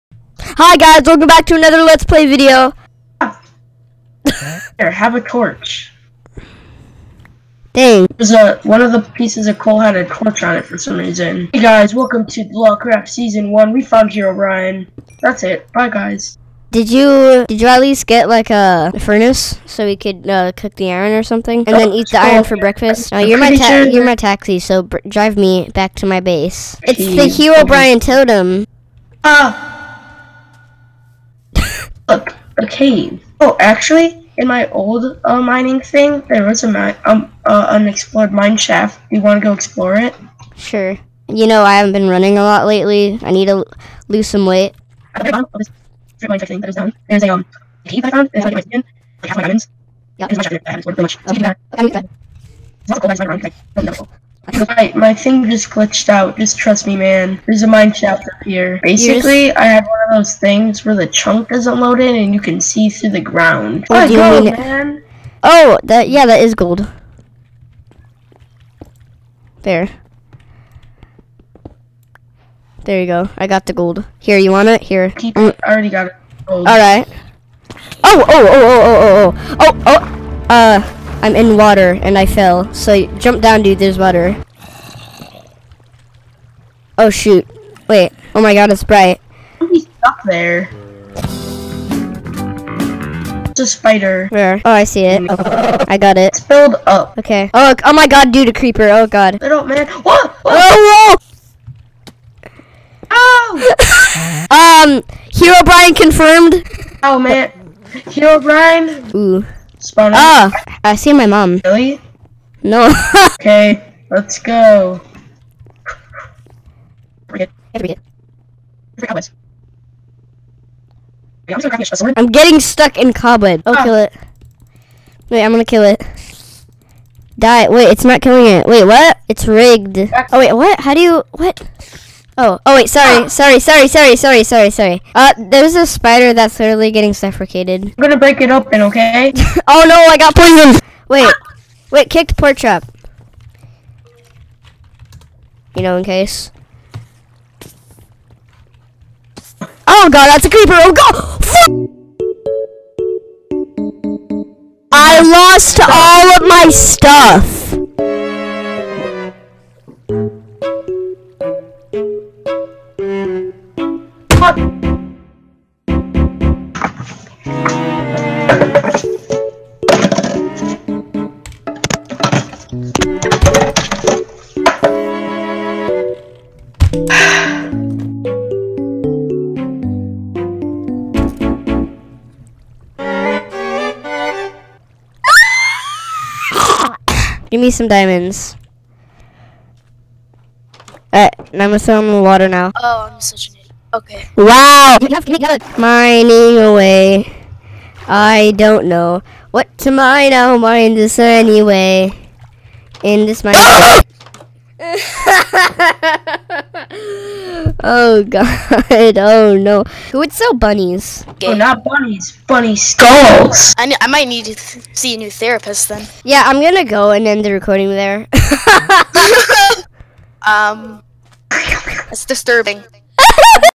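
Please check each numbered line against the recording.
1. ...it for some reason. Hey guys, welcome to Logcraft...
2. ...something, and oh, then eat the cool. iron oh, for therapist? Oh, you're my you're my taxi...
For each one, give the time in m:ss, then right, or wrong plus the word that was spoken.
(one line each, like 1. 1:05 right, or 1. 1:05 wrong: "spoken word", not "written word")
1. 0:10 right
2. 0:21 wrong: "breakfast", not "therapist".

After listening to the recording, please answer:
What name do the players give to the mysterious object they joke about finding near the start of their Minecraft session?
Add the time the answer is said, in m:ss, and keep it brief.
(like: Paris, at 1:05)
Herobrine totem, at 0:27.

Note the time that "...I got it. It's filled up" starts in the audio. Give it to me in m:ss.
1:35.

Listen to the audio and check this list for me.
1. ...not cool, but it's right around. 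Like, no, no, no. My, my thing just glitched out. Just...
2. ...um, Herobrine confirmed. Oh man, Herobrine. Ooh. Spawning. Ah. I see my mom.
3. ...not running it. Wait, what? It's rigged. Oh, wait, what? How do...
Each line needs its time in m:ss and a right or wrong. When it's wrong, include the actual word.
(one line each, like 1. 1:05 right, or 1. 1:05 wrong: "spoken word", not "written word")
1. 0:52 right
2. 1:44 right
3. 2:08 wrong: "killing", not "running".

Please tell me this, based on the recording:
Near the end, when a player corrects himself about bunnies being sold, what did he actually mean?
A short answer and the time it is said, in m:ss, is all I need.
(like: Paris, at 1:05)
Bunny skulls, at 3:32.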